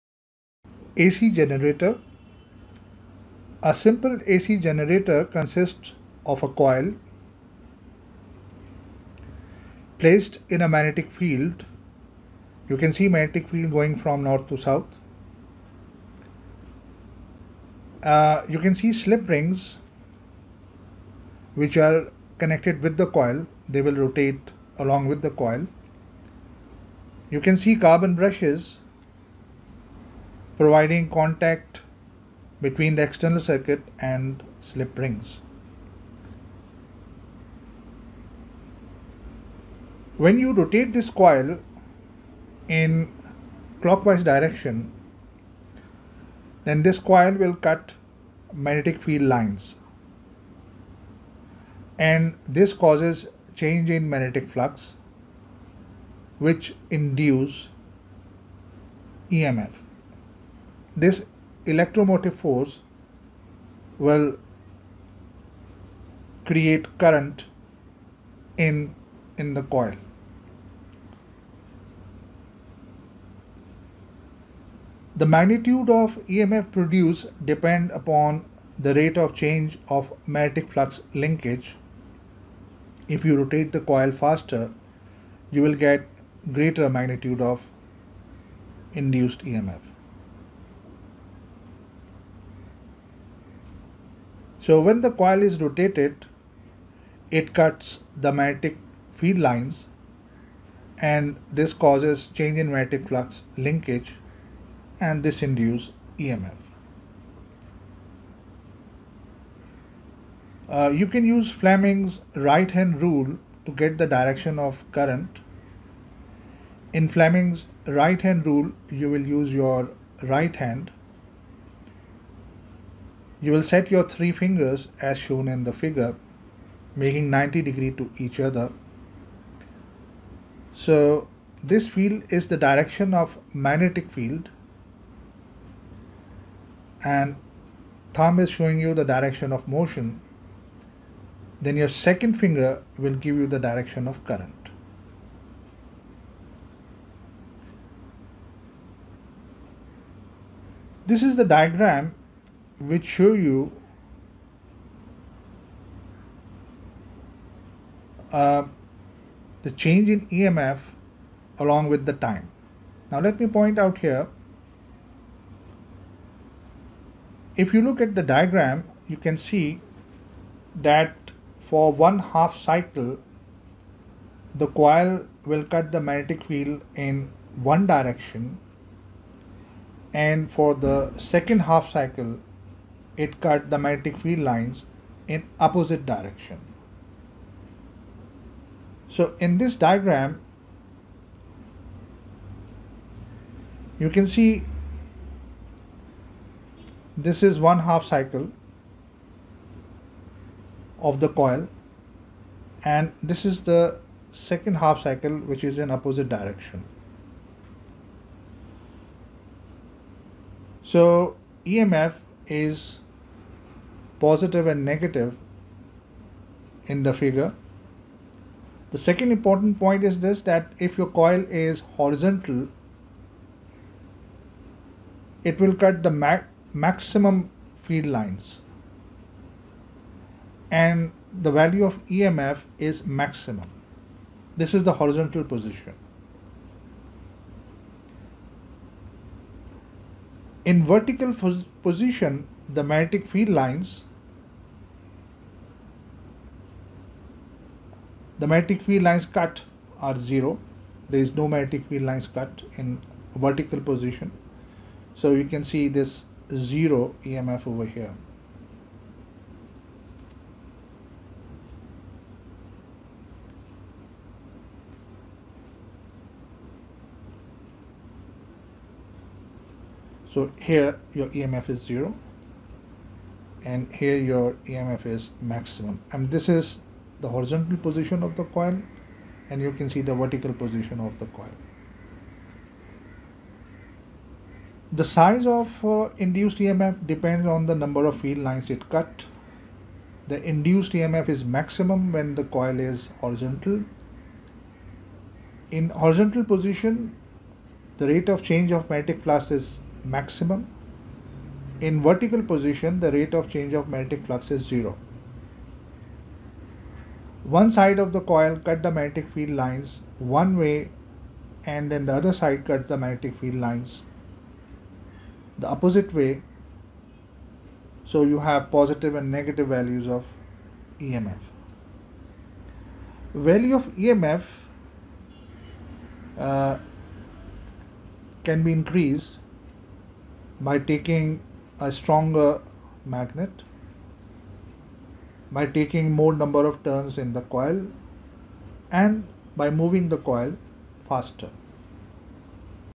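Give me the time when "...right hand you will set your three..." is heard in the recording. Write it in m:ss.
2:00.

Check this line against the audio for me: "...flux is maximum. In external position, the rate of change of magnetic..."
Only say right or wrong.
wrong.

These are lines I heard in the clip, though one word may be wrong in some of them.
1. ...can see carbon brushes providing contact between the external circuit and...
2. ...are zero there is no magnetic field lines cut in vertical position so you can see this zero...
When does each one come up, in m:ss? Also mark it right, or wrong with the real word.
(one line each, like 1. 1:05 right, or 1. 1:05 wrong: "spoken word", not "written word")
1. 0:27 right
2. 4:09 right.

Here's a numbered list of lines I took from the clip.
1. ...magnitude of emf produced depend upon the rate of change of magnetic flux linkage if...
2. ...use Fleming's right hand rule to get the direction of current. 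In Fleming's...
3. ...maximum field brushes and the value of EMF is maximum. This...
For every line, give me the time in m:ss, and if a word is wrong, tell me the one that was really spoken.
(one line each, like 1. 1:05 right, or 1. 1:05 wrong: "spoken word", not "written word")
1. 1:15 right
2. 1:51 right
3. 3:46 wrong: "lines", not "brushes".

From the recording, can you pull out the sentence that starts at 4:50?
The induced EMF is maximum when the coil is horizontal.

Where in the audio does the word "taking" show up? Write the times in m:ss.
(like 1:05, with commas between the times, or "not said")
5:30, 5:35.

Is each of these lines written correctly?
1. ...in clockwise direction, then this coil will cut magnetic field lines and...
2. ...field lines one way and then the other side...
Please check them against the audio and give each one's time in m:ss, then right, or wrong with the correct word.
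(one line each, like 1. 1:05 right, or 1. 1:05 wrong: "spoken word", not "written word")
1. 0:42 right
2. 5:09 right.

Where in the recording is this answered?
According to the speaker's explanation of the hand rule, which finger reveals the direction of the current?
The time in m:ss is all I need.
2:21.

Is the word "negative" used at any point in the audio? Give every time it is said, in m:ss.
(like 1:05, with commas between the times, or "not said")
3:34, 5:19.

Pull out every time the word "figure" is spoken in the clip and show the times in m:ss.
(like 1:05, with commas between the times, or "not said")
2:05, 3:37.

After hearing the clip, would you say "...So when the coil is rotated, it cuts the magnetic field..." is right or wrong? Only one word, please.
right.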